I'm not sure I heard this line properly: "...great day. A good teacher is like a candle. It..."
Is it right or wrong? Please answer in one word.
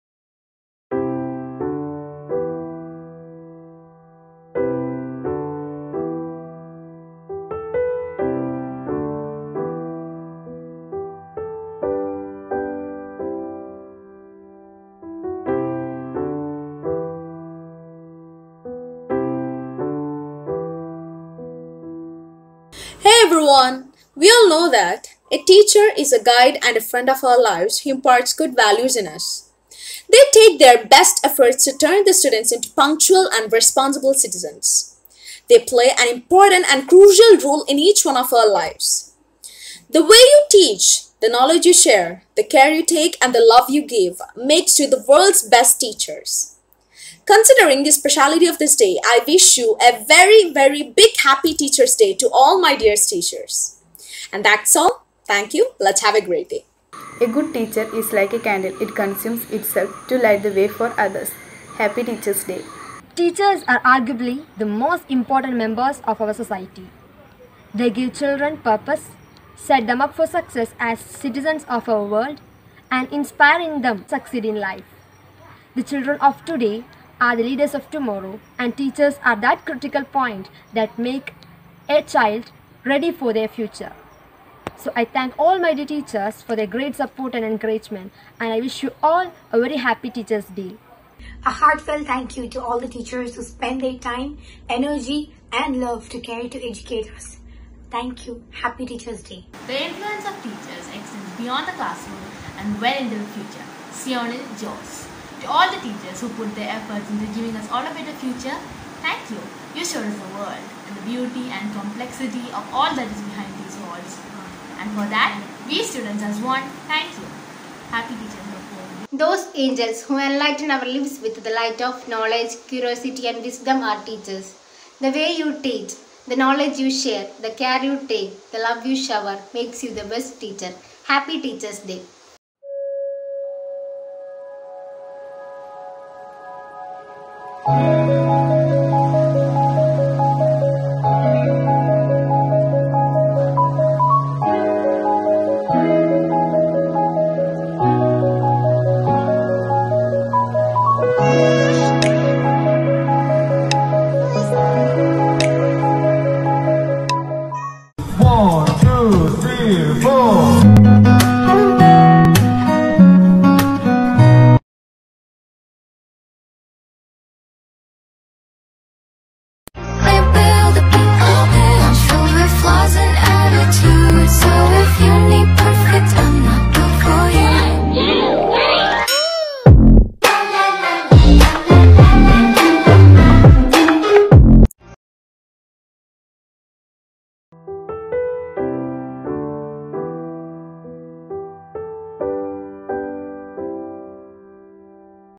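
right.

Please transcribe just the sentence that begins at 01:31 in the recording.
A heartfelt thank you to all the teachers who spend their time, energy and love to care to educate us.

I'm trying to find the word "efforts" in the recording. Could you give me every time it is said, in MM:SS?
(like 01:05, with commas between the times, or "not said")
00:31, 01:46.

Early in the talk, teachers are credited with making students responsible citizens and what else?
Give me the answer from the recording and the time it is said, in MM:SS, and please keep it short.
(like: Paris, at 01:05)
Punctual, at 00:32.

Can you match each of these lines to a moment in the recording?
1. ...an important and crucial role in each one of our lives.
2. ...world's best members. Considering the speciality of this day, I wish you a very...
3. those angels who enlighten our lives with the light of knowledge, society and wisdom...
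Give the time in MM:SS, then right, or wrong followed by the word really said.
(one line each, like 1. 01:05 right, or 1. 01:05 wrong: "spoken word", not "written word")
1. 00:35 right
2. 00:45 wrong: "teachers", not "members"
3. 01:59 wrong: "curiosity", not "society".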